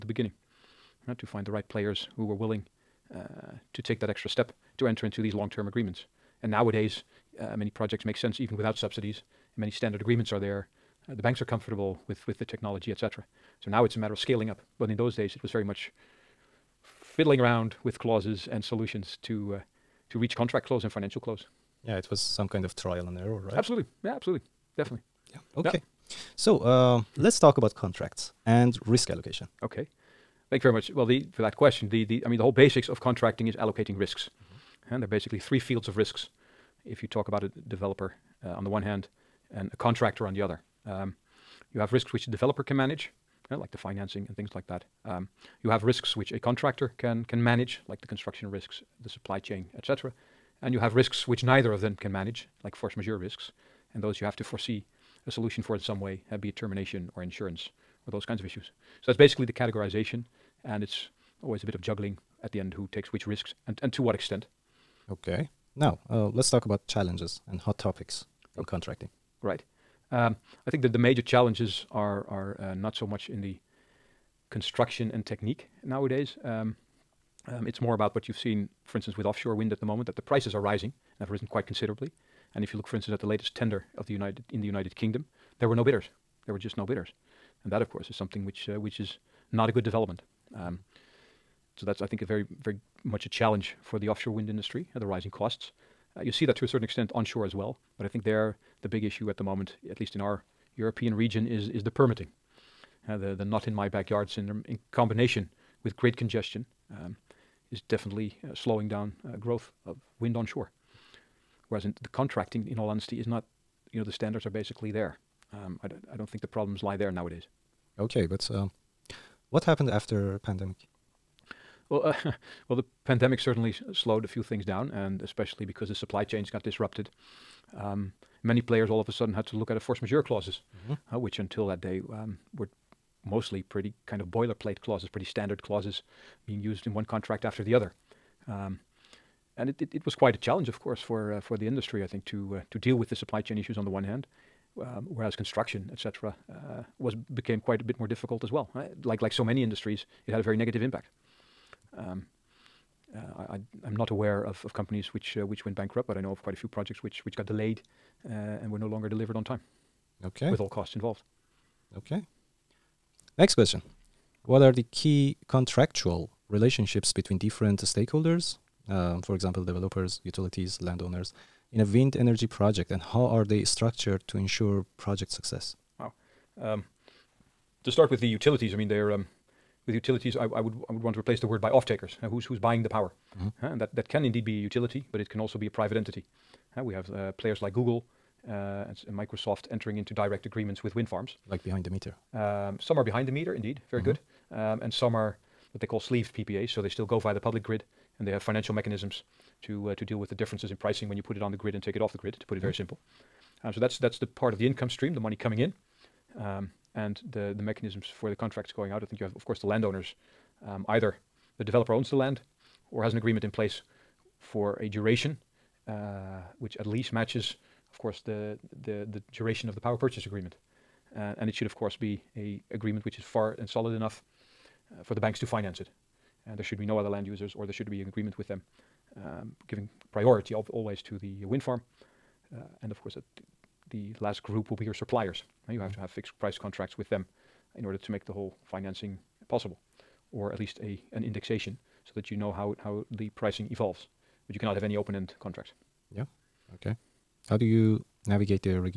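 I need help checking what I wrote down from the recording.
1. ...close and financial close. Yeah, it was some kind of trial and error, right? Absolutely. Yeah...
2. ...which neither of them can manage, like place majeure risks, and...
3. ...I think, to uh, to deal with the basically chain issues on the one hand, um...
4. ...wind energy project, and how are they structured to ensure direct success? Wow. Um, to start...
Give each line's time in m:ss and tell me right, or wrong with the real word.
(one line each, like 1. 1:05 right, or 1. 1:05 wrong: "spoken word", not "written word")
1. 0:20 right
2. 0:51 wrong: "force", not "place"
3. 2:22 wrong: "supply", not "basically"
4. 2:51 wrong: "project", not "direct".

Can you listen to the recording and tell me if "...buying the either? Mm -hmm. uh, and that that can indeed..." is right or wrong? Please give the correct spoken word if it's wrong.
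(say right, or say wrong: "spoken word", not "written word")
wrong: "power", not "either".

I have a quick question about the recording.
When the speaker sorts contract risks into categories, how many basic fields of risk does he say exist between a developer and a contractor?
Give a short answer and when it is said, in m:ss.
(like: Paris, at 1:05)
3, at 0:35.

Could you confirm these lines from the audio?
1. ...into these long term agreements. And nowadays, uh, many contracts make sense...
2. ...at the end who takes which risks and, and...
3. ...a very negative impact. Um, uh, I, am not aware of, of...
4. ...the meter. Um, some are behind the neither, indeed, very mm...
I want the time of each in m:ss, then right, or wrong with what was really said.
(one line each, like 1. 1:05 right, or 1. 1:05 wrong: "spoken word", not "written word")
1. 0:05 wrong: "projects", not "contracts"
2. 1:02 right
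3. 2:30 right
4. 3:11 wrong: "meter", not "neither".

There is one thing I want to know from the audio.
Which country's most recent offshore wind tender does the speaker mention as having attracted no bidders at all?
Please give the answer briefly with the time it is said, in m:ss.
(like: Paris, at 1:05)
United Kingdom, at 1:24.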